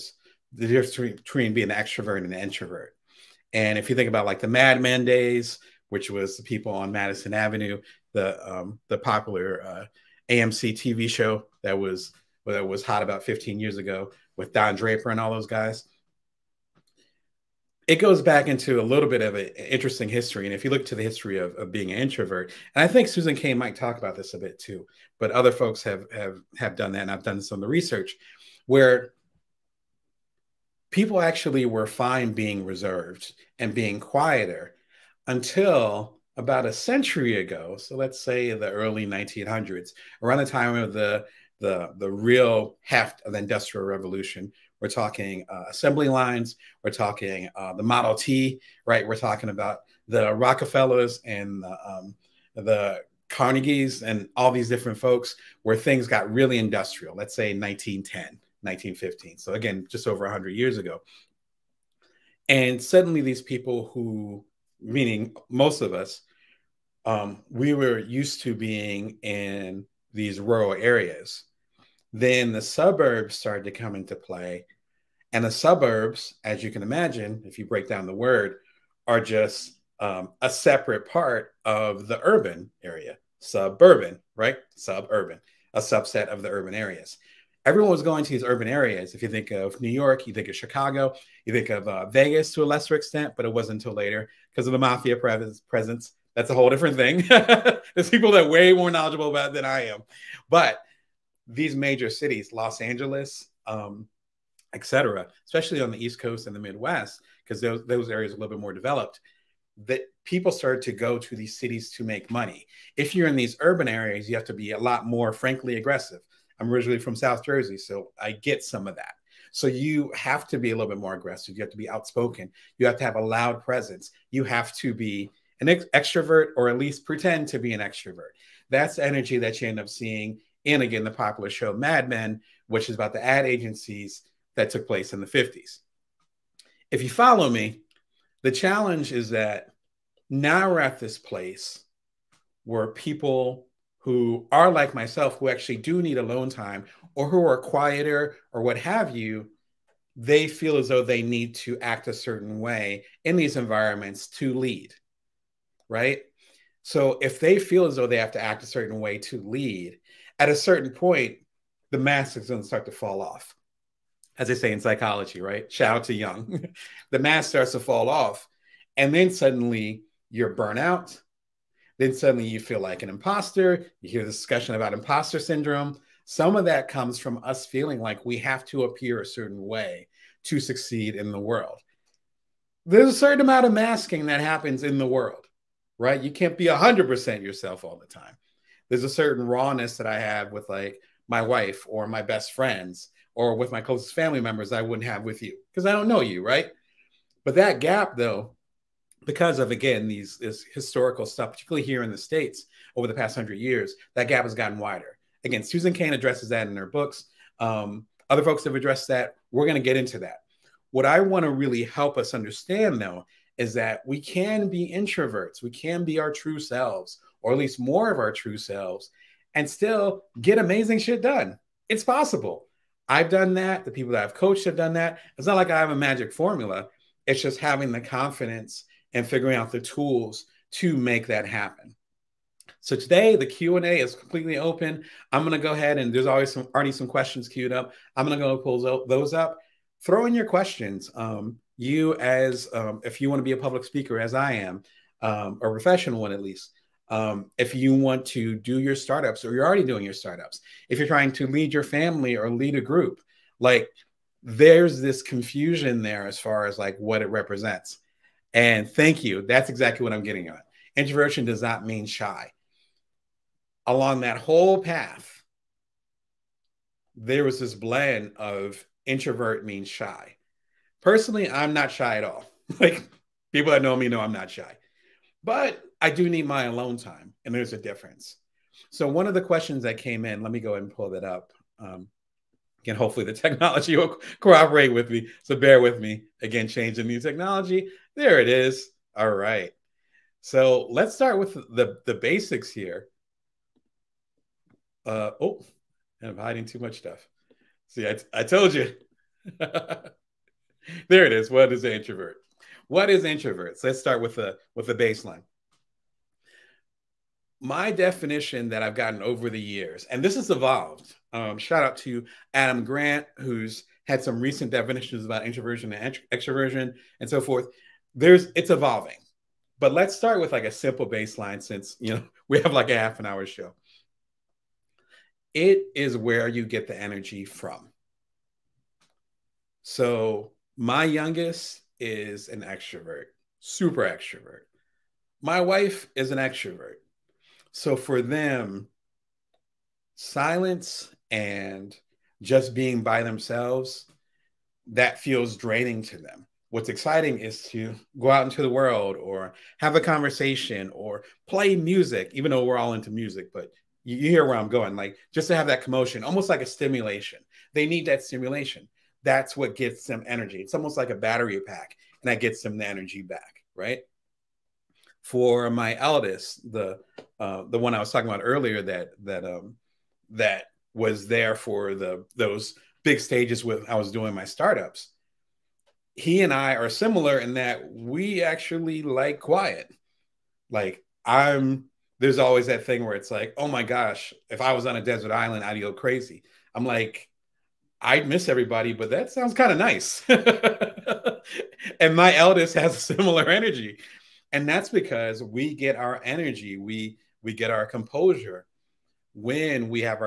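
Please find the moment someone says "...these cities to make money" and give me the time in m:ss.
1:51.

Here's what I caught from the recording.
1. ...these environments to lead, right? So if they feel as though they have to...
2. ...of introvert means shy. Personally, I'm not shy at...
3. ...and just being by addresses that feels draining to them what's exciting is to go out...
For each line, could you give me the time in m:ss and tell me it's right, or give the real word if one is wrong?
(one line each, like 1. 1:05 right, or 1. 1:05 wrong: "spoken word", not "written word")
1. 2:33 right
2. 4:28 right
3. 5:41 wrong: "themselves", not "addresses".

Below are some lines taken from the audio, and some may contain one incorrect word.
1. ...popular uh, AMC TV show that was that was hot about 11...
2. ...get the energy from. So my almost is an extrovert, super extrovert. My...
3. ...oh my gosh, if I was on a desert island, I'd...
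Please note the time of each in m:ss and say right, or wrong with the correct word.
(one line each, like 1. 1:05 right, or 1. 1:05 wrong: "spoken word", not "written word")
1. 0:08 wrong: "15", not "11"
2. 5:26 wrong: "youngest", not "almost"
3. 6:23 right.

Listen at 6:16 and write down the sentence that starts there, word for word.
He and I are similar in that we actually like quiet.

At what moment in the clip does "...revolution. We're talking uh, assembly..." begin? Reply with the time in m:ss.
0:43.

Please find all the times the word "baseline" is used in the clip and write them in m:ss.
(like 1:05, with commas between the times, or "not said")
5:04, 5:21.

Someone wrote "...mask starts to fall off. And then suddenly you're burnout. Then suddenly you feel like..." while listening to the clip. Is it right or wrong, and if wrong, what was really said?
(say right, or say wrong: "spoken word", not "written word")
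right.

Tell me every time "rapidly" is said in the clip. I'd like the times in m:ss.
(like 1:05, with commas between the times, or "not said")
not said.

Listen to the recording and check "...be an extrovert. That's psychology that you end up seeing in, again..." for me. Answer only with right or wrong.
wrong.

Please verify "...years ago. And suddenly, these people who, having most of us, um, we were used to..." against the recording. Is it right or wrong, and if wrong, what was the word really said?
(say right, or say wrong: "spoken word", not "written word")
wrong: "meaning", not "having".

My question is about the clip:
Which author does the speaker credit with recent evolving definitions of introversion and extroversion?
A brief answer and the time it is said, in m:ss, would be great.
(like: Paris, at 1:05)
Adam Grant, at 5:12.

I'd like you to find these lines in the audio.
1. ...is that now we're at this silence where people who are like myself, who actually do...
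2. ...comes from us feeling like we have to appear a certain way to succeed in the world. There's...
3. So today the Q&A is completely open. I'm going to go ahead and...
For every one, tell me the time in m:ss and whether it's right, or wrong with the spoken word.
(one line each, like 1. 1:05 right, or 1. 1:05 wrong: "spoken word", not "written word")
1. 2:19 wrong: "place", not "silence"
2. 2:56 right
3. 3:52 right.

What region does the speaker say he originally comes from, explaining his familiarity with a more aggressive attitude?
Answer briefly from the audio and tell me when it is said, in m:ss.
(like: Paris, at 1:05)
South Jersey, at 1:57.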